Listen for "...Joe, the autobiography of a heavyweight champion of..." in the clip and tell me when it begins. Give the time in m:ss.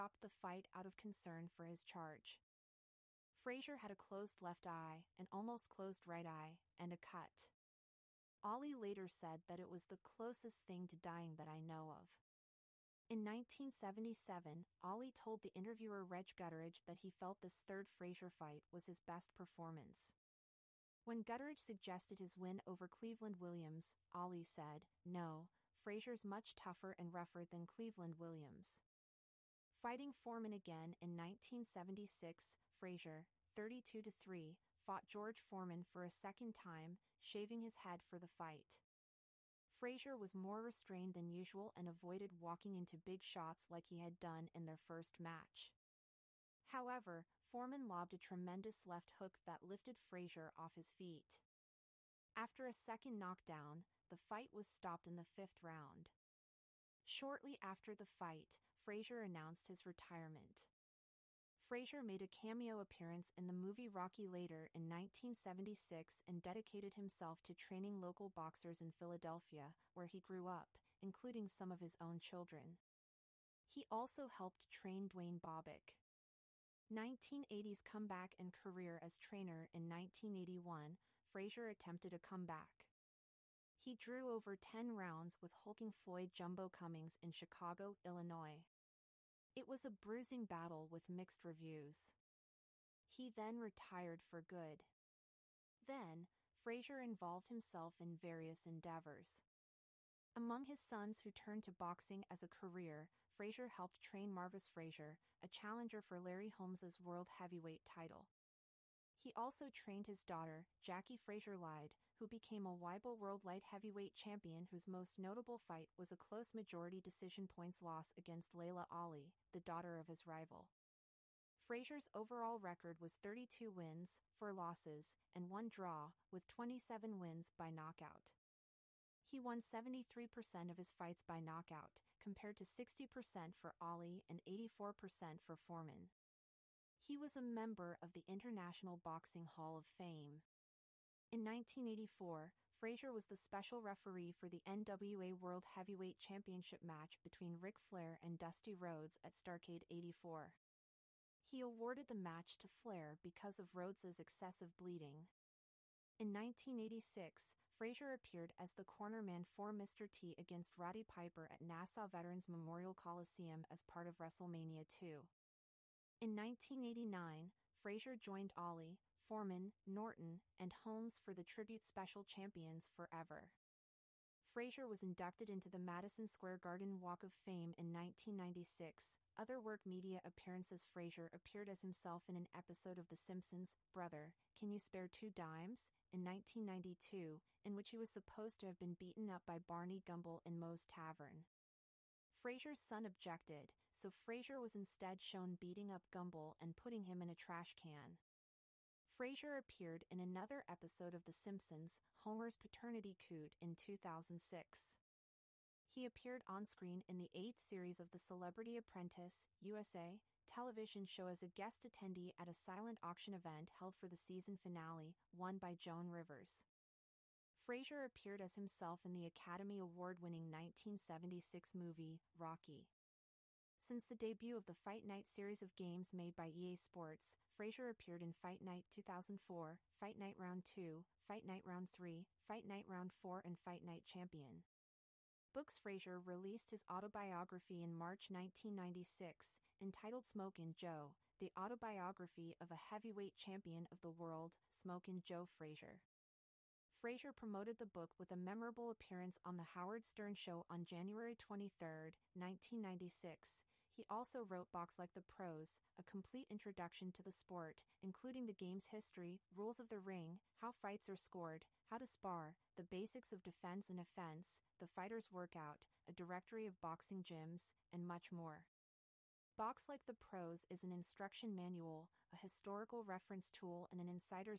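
4:00.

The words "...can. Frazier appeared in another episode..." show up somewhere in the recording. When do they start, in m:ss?
3:17.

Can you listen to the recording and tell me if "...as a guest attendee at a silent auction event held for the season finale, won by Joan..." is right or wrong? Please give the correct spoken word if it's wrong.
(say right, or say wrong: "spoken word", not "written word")
right.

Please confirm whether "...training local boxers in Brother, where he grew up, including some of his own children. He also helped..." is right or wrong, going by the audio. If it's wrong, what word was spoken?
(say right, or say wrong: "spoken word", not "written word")
wrong: "Philadelphia", not "Brother".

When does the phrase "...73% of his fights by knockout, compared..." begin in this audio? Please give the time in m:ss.
2:09.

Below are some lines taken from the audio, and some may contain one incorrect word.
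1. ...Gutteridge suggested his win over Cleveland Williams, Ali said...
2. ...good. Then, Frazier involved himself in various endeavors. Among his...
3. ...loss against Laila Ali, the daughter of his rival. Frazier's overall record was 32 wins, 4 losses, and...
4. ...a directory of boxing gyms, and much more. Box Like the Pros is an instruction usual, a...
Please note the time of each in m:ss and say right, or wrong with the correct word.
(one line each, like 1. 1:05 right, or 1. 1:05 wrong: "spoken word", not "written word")
1. 0:21 right
2. 1:34 right
3. 1:57 right
4. 4:26 wrong: "manual", not "usual".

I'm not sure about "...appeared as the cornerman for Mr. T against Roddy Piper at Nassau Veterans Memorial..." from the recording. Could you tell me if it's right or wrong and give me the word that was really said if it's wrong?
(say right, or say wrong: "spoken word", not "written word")
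right.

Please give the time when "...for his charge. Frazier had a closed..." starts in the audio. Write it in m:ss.
0:01.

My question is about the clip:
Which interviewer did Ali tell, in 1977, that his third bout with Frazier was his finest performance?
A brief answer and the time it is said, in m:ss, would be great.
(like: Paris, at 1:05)
Reg Gutteridge, at 0:16.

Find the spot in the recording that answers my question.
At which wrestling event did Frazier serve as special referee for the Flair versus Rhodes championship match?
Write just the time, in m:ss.
2:29.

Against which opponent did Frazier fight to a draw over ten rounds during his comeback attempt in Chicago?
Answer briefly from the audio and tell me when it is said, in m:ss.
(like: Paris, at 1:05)
Floyd Jumbo Cummings, at 1:25.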